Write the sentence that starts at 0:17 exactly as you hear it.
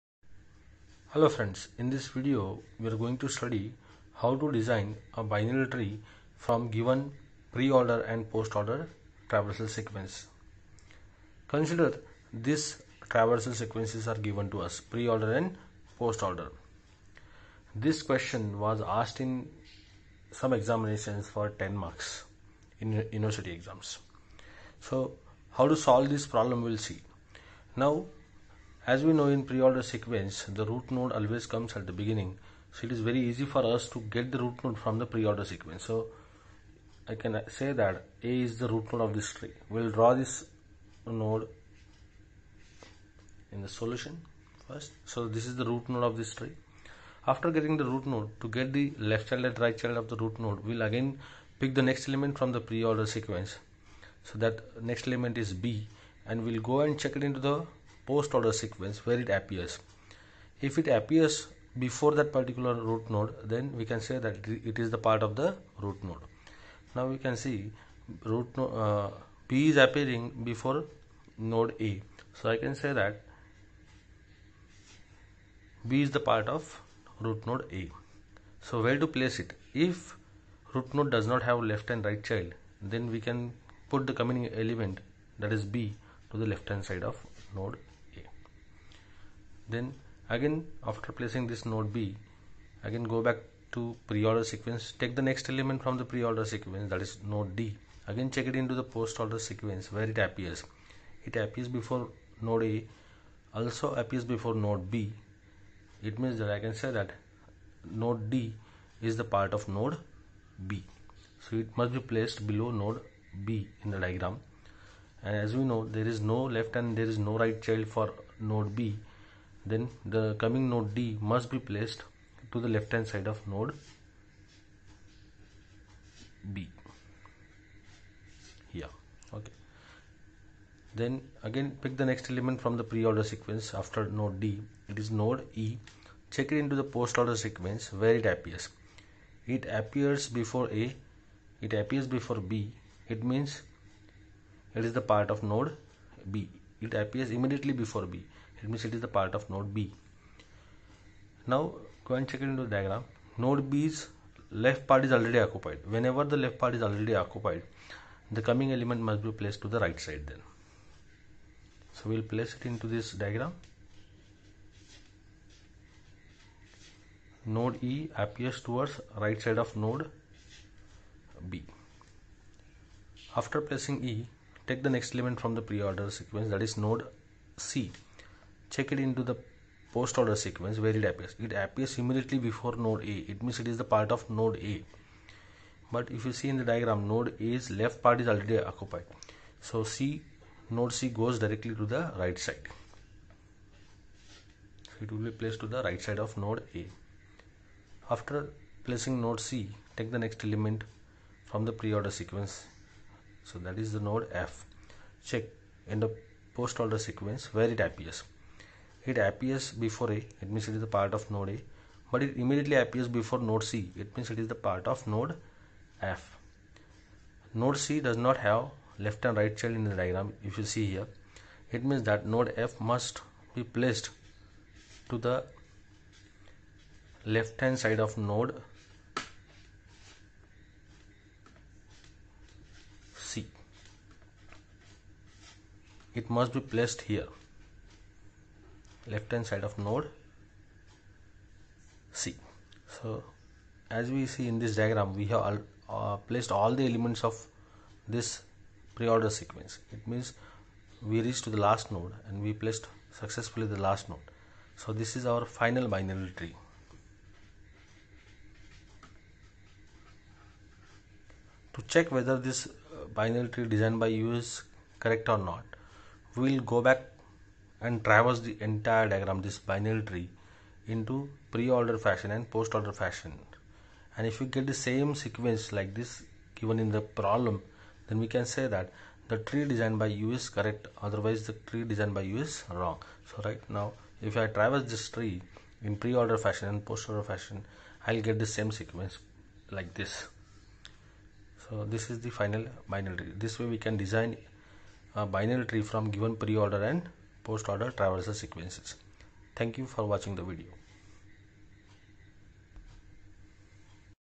This question was asked in some examinations for 10 marks in university exams.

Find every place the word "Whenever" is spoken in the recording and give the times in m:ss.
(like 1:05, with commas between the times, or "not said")
2:35.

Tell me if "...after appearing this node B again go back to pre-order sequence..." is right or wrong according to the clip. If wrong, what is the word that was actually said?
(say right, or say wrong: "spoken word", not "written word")
wrong: "placing", not "appearing".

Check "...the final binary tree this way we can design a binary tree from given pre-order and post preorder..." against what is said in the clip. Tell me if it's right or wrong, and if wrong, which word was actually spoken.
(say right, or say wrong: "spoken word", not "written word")
wrong: "order", not "preorder".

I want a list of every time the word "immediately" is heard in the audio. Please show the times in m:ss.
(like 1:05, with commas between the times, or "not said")
2:27, 3:02, 3:32.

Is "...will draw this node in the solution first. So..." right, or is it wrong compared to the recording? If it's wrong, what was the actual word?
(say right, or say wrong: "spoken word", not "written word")
right.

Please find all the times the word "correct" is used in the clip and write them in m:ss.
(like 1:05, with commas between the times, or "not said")
4:24, 4:40.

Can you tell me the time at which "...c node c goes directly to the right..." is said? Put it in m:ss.
3:09.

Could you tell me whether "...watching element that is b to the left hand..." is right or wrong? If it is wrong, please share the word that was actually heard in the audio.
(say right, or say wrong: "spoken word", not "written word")
wrong: "coming", not "watching".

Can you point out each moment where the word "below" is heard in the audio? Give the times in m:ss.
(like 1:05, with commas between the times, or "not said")
1:52.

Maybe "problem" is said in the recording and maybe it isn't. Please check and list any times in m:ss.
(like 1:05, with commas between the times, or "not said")
0:26, 4:37.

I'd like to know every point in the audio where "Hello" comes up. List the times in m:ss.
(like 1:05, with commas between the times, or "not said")
0:01.